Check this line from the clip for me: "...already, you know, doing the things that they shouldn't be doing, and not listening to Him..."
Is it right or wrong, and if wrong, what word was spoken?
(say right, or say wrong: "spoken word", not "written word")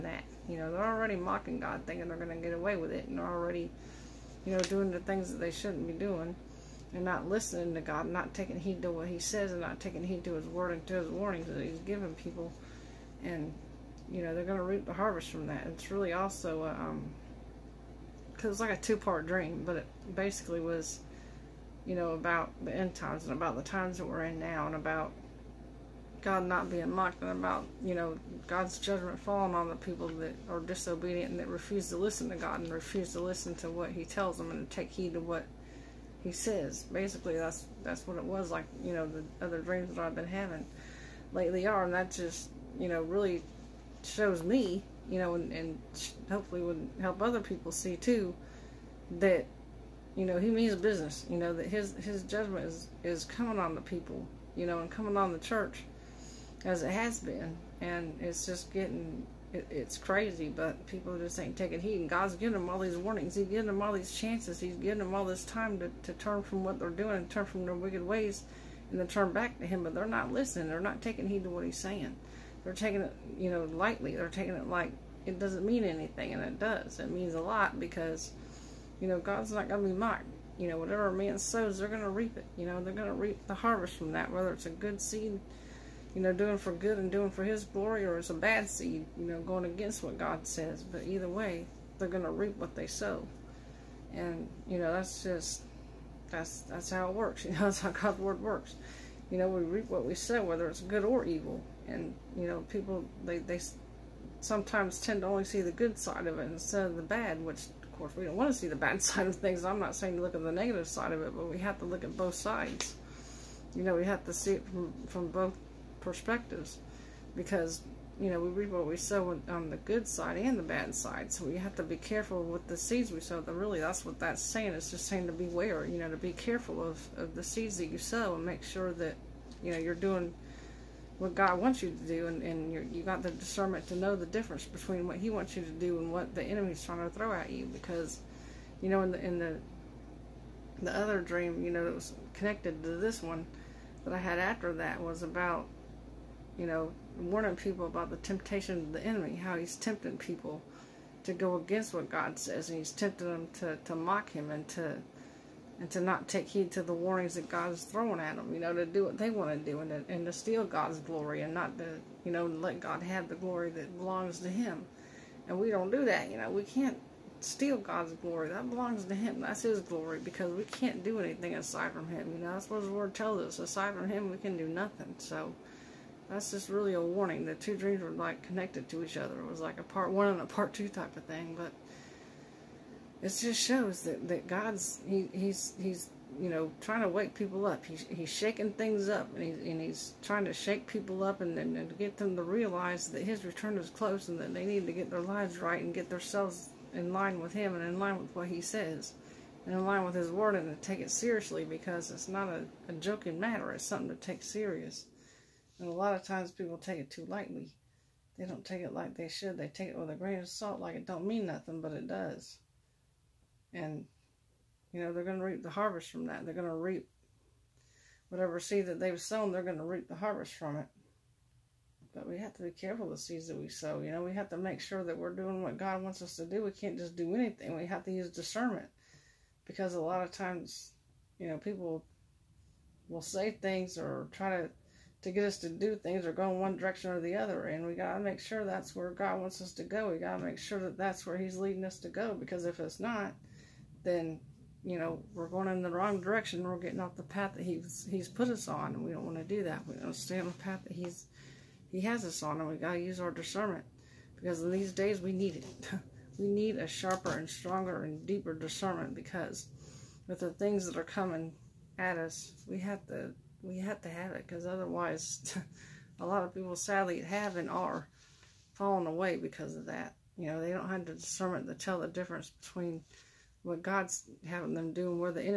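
wrong: "God", not "Him".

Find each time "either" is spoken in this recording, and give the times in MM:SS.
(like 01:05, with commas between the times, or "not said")
01:31.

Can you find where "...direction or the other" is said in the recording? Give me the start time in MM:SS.
03:56.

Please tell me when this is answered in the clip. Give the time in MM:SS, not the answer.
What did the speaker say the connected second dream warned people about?
02:28.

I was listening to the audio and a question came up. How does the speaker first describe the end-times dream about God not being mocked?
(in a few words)
two-part dream.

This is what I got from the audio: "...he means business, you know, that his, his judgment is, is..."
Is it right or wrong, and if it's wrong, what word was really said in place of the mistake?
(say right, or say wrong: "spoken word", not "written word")
right.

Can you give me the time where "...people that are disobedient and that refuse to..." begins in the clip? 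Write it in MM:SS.
00:29.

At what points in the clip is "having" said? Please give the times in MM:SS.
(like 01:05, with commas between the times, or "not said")
00:40, 04:34.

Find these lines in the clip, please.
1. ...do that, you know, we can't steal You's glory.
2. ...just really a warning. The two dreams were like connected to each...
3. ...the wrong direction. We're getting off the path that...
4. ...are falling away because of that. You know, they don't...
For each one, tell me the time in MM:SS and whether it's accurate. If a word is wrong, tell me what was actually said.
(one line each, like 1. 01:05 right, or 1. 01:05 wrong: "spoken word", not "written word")
1. 02:45 wrong: "God", not "You"
2. 02:56 right
3. 04:05 right
4. 04:27 right.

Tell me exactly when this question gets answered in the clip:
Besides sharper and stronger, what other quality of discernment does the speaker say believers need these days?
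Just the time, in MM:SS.
04:18.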